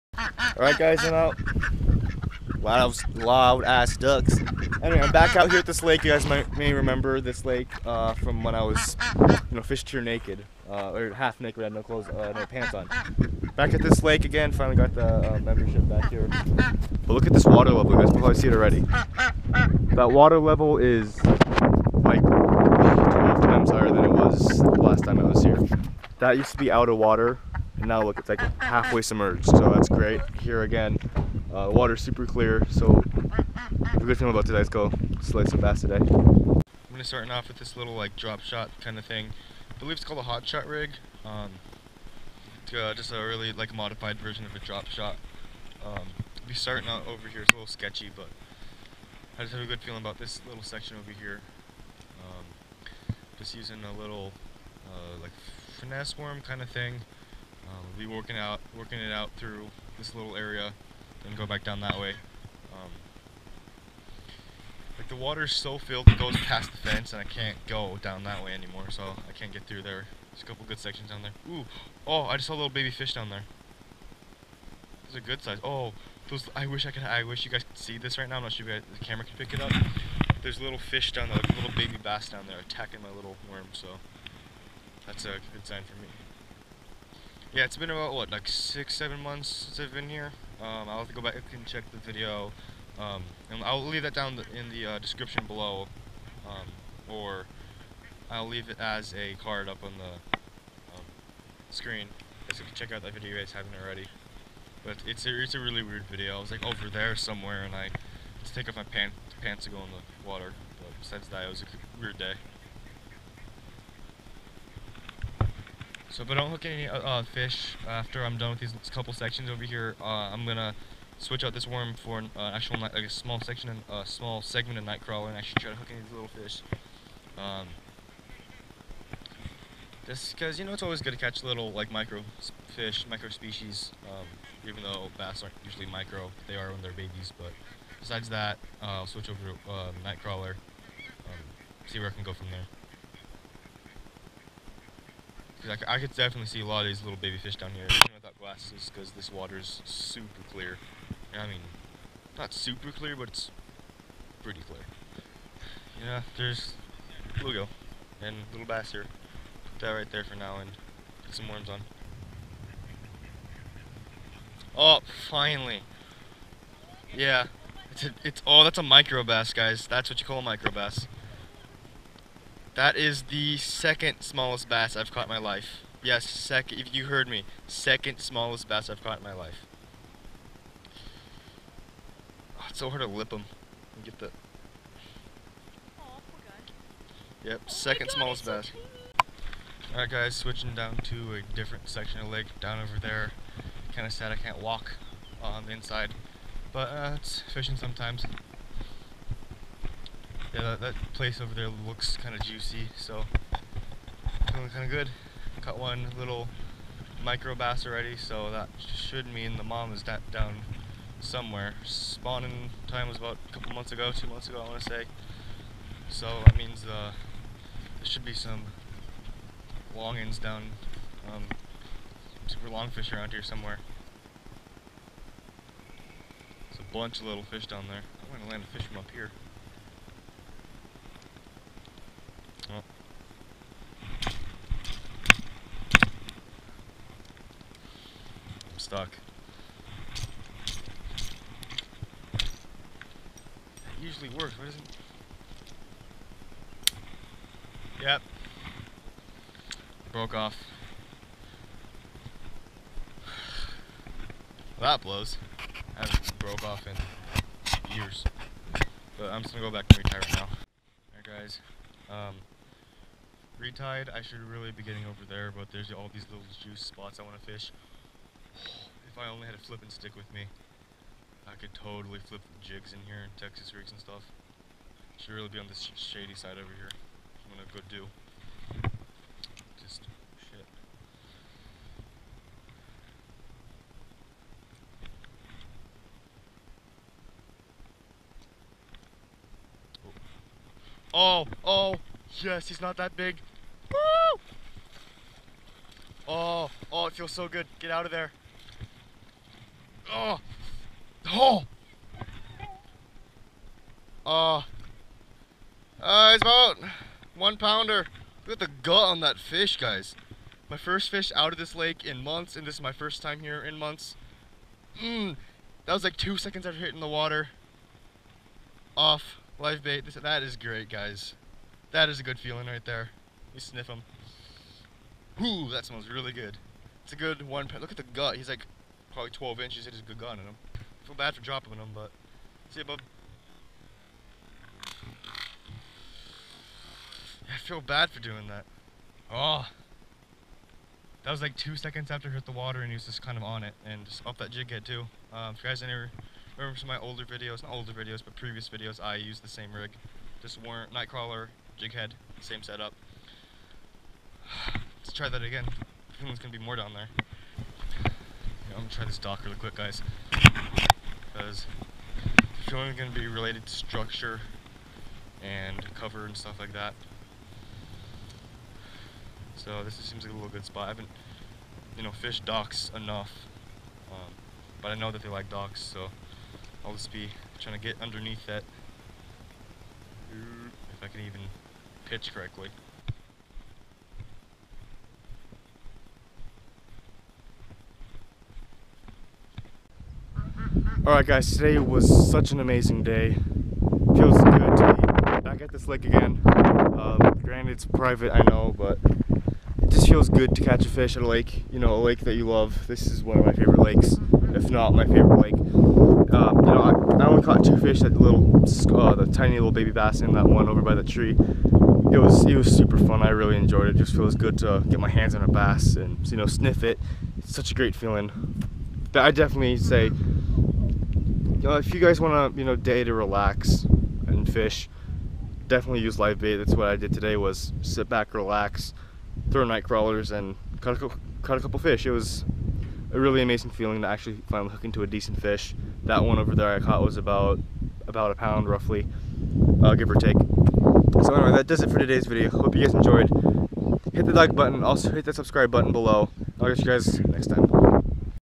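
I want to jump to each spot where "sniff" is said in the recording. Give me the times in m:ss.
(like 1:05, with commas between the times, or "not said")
5:23, 6:56.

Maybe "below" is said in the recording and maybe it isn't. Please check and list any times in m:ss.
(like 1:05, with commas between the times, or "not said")
1:35, 7:25.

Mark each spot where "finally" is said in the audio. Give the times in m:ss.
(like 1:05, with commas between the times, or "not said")
0:14, 2:45, 7:14.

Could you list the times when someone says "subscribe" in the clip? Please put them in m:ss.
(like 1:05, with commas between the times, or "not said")
7:25.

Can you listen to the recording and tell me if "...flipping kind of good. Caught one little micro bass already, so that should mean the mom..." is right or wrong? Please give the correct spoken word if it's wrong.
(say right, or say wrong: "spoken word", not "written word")
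wrong: "feeling", not "flipping".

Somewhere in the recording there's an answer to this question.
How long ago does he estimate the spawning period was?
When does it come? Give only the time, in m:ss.
3:34.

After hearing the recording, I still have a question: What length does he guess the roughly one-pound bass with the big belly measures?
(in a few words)
12 inches.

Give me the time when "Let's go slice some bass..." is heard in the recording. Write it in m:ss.
0:34.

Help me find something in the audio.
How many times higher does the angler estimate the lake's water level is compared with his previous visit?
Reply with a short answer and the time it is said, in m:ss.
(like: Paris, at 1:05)
12, at 0:22.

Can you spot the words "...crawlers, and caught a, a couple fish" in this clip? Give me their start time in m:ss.
7:09.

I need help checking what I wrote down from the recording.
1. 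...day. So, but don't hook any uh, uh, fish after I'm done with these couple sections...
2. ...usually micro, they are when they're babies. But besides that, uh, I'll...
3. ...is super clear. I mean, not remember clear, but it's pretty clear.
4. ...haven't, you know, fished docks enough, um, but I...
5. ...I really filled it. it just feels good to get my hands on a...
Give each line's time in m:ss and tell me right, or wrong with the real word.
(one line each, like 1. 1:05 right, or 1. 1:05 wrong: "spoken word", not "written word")
1. 1:52 right
2. 2:15 right
3. 2:29 wrong: "super", not "remember"
4. 6:10 right
5. 6:53 wrong: "enjoyed", not "filled".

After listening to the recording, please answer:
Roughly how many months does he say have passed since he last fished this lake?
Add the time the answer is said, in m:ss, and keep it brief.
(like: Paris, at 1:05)
six, seven months, at 1:28.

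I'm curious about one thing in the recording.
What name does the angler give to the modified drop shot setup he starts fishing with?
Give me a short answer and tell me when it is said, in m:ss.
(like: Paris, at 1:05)
hot shot rig, at 0:40.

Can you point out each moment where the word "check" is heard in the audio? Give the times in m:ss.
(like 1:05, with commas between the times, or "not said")
1:31, 1:42.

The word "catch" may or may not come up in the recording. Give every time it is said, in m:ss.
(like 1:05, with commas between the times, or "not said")
2:11, 6:40, 7:26.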